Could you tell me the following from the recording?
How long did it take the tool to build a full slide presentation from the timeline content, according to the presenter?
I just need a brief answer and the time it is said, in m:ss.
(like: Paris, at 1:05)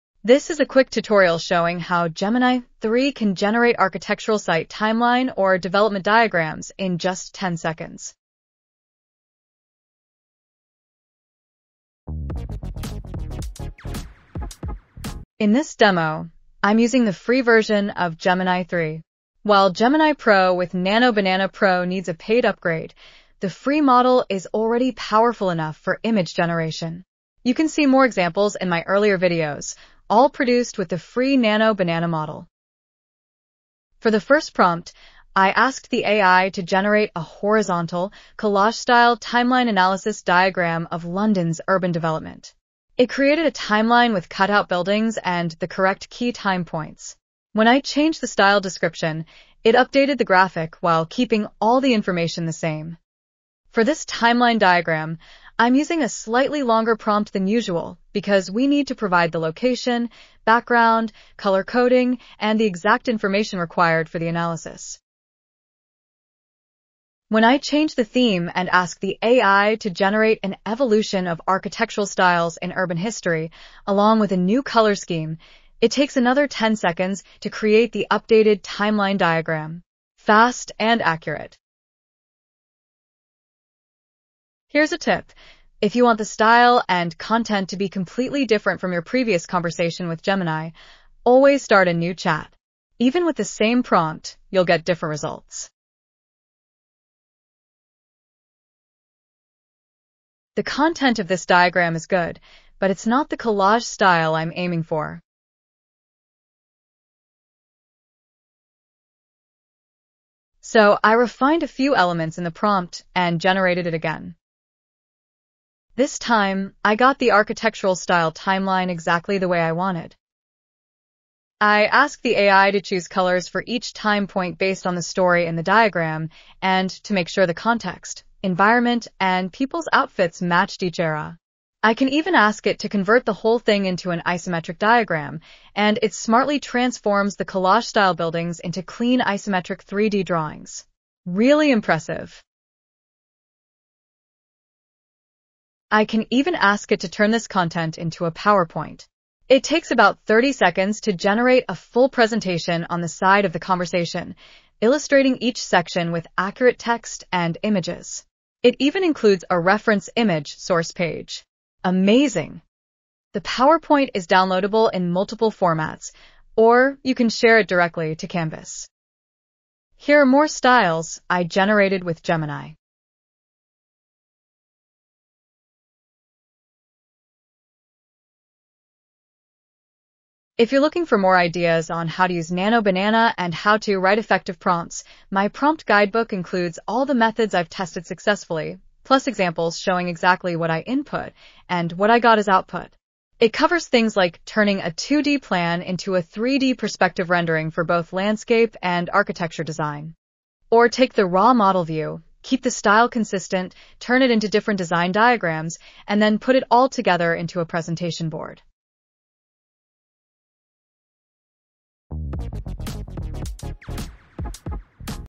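30 seconds, at 2:30.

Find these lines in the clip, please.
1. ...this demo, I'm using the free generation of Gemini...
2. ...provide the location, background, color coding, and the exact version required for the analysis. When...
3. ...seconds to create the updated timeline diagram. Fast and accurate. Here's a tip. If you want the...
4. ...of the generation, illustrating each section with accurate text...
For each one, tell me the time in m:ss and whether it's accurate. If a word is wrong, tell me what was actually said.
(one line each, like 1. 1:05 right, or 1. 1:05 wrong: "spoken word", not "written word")
1. 0:15 wrong: "version", not "generation"
2. 0:58 wrong: "information", not "version"
3. 1:16 right
4. 2:33 wrong: "conversation", not "generation".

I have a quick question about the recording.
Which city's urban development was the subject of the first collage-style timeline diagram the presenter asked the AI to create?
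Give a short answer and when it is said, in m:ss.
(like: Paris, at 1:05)
London, at 0:41.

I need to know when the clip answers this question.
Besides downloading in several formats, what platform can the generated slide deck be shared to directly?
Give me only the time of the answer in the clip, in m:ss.
2:48.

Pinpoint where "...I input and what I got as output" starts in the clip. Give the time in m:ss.
3:10.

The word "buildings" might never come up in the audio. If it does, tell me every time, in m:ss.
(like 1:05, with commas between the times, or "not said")
0:44, 2:18.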